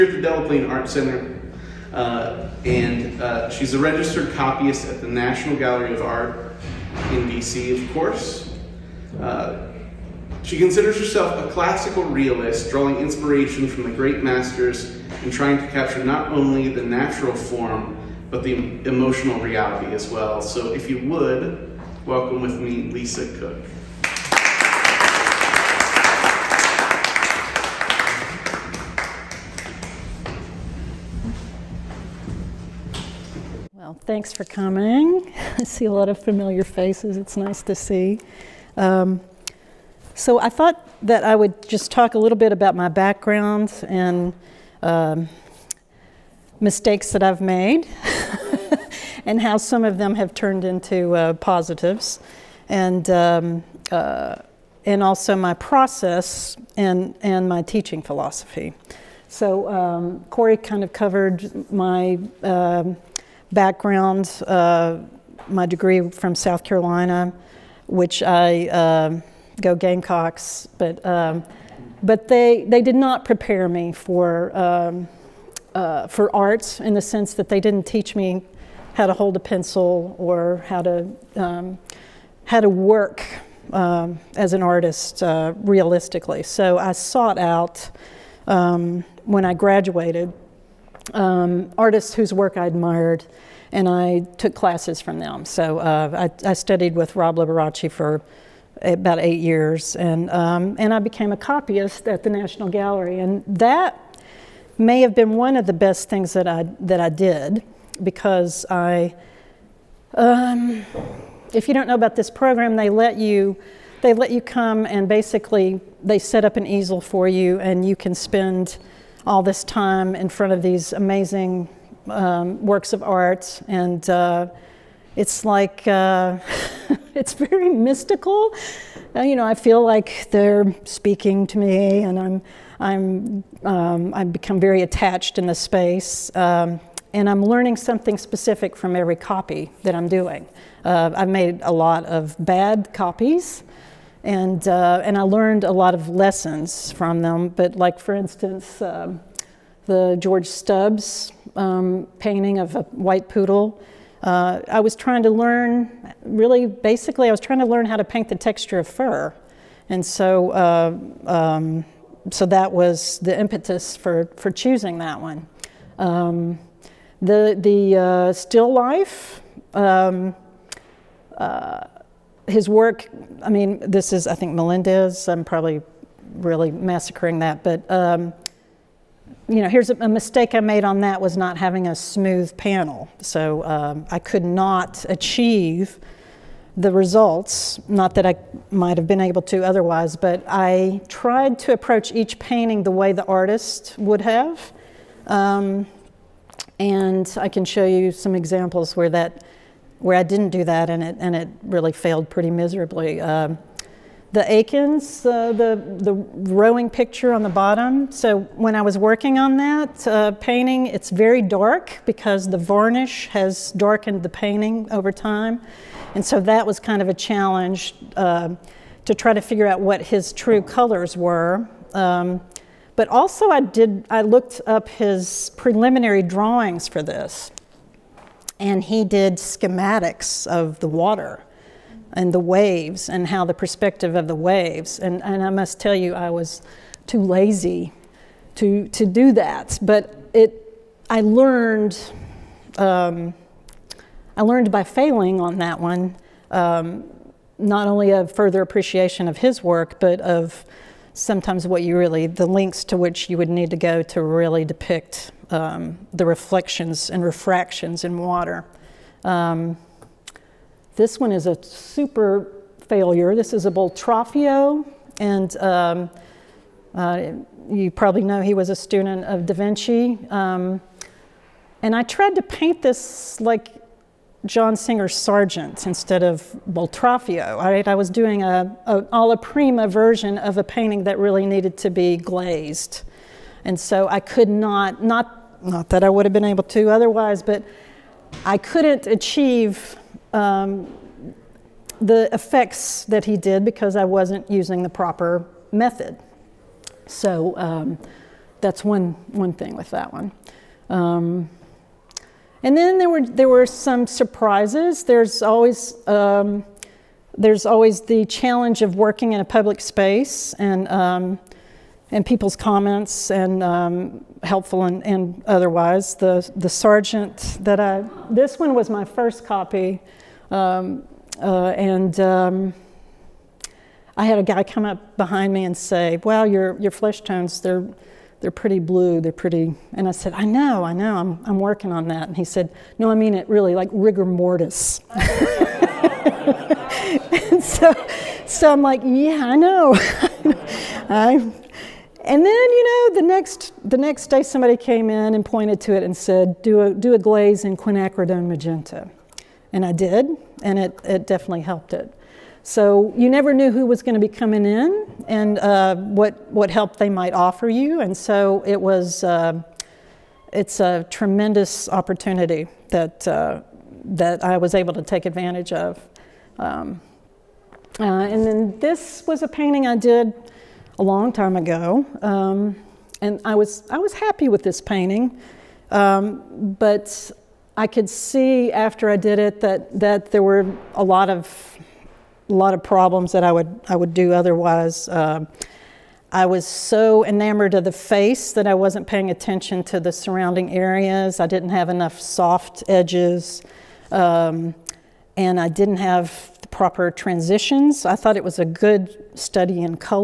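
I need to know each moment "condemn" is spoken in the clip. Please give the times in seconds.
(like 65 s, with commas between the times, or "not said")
not said.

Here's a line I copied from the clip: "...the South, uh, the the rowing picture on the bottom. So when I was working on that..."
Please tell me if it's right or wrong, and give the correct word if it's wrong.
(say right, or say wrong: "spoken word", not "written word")
wrong: "Eakins", not "South".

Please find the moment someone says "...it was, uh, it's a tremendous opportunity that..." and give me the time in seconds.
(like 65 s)
358 s.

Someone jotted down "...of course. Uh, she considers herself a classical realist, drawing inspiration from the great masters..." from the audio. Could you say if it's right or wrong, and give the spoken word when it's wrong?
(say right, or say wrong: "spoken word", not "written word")
right.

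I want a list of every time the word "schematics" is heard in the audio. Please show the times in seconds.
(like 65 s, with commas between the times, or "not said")
229 s.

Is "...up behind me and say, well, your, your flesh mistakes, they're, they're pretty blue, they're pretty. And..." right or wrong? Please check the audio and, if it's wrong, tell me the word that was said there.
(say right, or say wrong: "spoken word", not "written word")
wrong: "tones", not "mistakes".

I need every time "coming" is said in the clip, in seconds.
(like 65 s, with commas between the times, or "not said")
34 s, 354 s.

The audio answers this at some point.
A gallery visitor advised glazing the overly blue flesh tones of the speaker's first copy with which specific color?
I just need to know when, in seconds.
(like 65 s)
347 s.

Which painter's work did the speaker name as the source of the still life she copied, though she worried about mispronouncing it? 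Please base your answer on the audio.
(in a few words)
Melendez.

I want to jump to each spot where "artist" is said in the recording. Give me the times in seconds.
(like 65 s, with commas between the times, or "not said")
84 s, 91 s, 193 s.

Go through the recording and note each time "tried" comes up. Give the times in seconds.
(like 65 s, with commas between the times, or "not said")
191 s, 272 s.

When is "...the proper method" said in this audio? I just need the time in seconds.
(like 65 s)
294 s.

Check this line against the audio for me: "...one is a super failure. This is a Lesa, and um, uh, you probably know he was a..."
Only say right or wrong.
wrong.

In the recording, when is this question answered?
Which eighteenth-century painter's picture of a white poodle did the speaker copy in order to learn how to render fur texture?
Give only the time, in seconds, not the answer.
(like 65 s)
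150 s.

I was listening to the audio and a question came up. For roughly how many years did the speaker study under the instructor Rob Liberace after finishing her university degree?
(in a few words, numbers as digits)
8.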